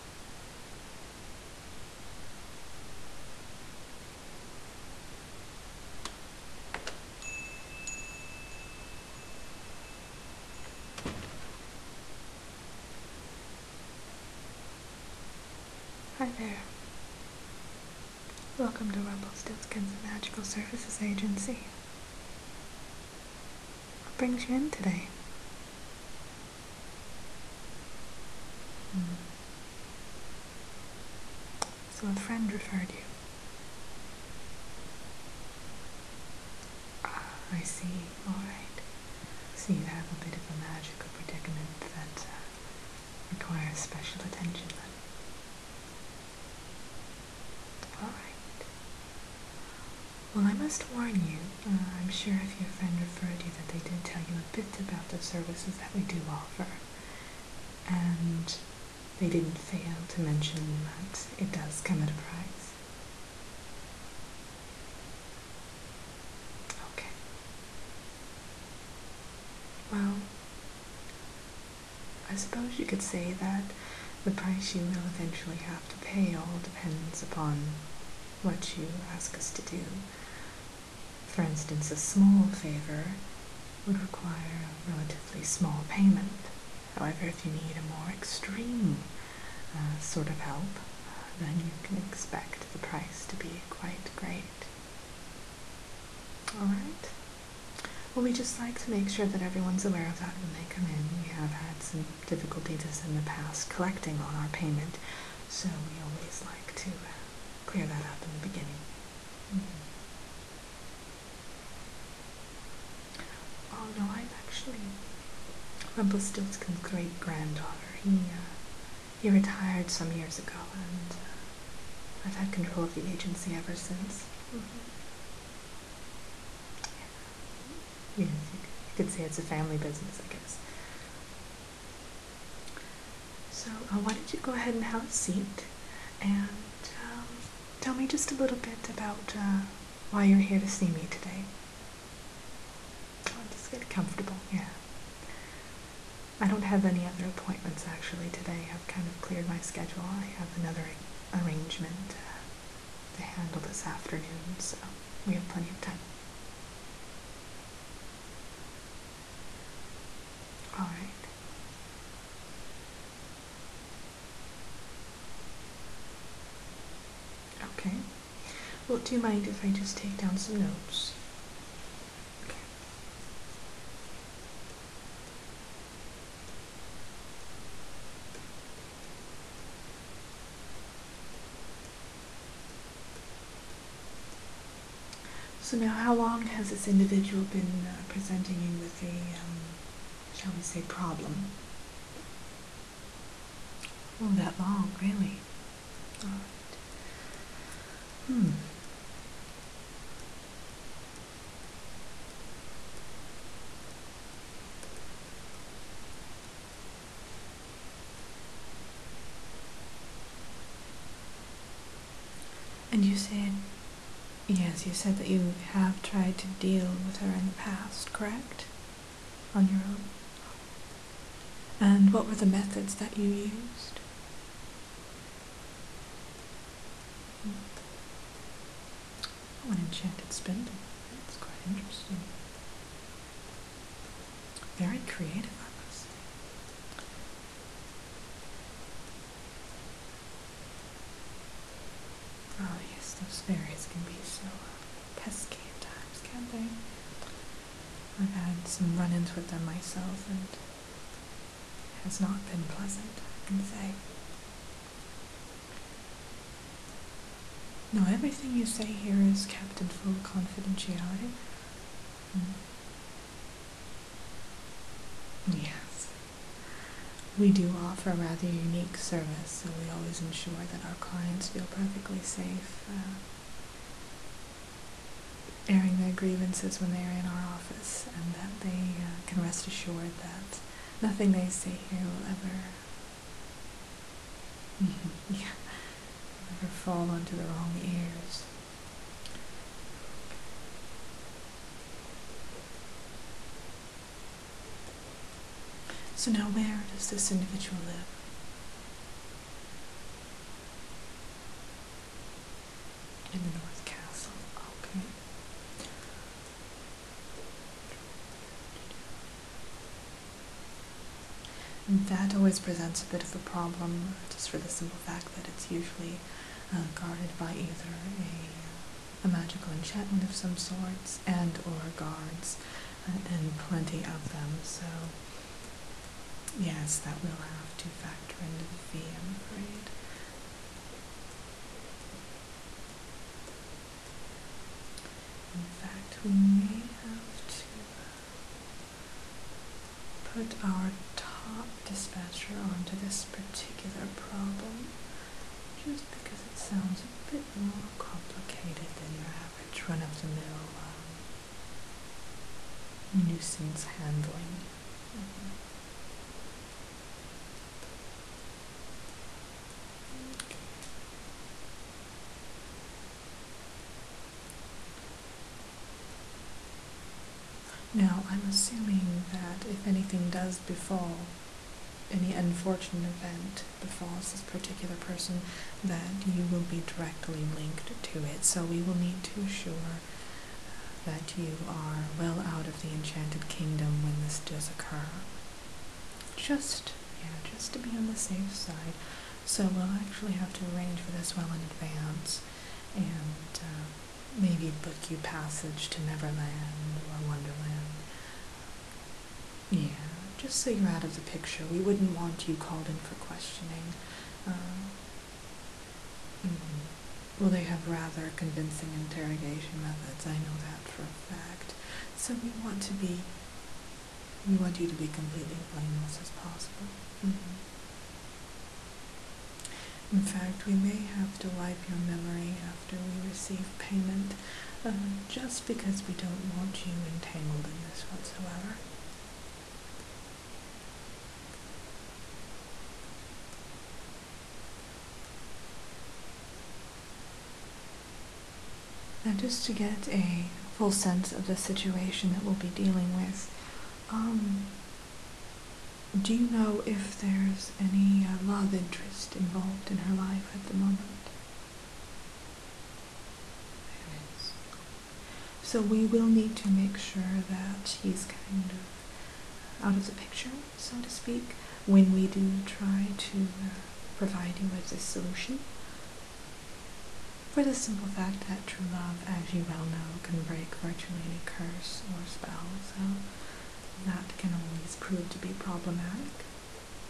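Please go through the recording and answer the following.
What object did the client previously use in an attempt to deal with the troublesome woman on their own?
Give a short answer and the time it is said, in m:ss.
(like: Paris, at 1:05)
An enchanted spindle, at 3:49.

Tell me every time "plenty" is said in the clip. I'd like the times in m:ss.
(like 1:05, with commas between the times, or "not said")
2:35, 5:23.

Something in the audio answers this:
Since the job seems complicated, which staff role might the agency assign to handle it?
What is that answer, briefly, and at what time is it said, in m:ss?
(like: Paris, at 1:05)
Top dispatcher, at 5:41.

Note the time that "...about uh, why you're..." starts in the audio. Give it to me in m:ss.
2:18.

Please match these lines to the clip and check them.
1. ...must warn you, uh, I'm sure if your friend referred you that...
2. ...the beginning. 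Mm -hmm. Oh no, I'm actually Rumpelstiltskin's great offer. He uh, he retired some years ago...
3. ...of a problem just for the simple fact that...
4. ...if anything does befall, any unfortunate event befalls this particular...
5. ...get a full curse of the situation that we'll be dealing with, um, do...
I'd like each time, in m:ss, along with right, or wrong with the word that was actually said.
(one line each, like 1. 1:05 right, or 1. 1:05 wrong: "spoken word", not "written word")
1. 0:50 right
2. 1:48 wrong: "granddaughter", not "offer"
3. 5:13 right
4. 6:09 right
5. 7:19 wrong: "sense", not "curse".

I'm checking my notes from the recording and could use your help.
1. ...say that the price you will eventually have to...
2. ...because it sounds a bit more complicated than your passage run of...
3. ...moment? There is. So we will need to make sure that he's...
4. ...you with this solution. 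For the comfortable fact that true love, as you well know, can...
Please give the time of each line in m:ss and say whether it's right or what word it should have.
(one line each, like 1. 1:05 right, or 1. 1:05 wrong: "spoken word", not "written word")
1. 1:13 right
2. 5:46 wrong: "average", not "passage"
3. 7:30 right
4. 7:44 wrong: "simple", not "comfortable".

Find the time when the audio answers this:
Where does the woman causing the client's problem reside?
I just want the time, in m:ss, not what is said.
5:03.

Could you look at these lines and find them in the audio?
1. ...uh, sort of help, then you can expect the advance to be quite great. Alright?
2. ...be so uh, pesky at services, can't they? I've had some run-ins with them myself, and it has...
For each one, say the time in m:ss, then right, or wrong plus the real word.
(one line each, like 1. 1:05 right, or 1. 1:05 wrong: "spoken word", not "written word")
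1. 1:29 wrong: "price", not "advance"
2. 4:04 wrong: "times", not "services".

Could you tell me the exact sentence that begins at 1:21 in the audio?
For instance, a small favor would require a relatively small payment.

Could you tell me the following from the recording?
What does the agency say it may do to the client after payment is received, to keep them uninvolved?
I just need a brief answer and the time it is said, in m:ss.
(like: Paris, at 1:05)
Wipe your memory, at 7:01.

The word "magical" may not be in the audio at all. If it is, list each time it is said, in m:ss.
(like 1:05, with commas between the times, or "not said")
0:20, 0:40, 5:19.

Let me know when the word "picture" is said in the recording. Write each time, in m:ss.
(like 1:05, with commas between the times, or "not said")
6:41, 7:40.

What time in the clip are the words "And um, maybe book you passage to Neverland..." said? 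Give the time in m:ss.
6:32.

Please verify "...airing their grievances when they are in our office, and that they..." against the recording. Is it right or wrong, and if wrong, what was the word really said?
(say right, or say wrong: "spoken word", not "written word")
right.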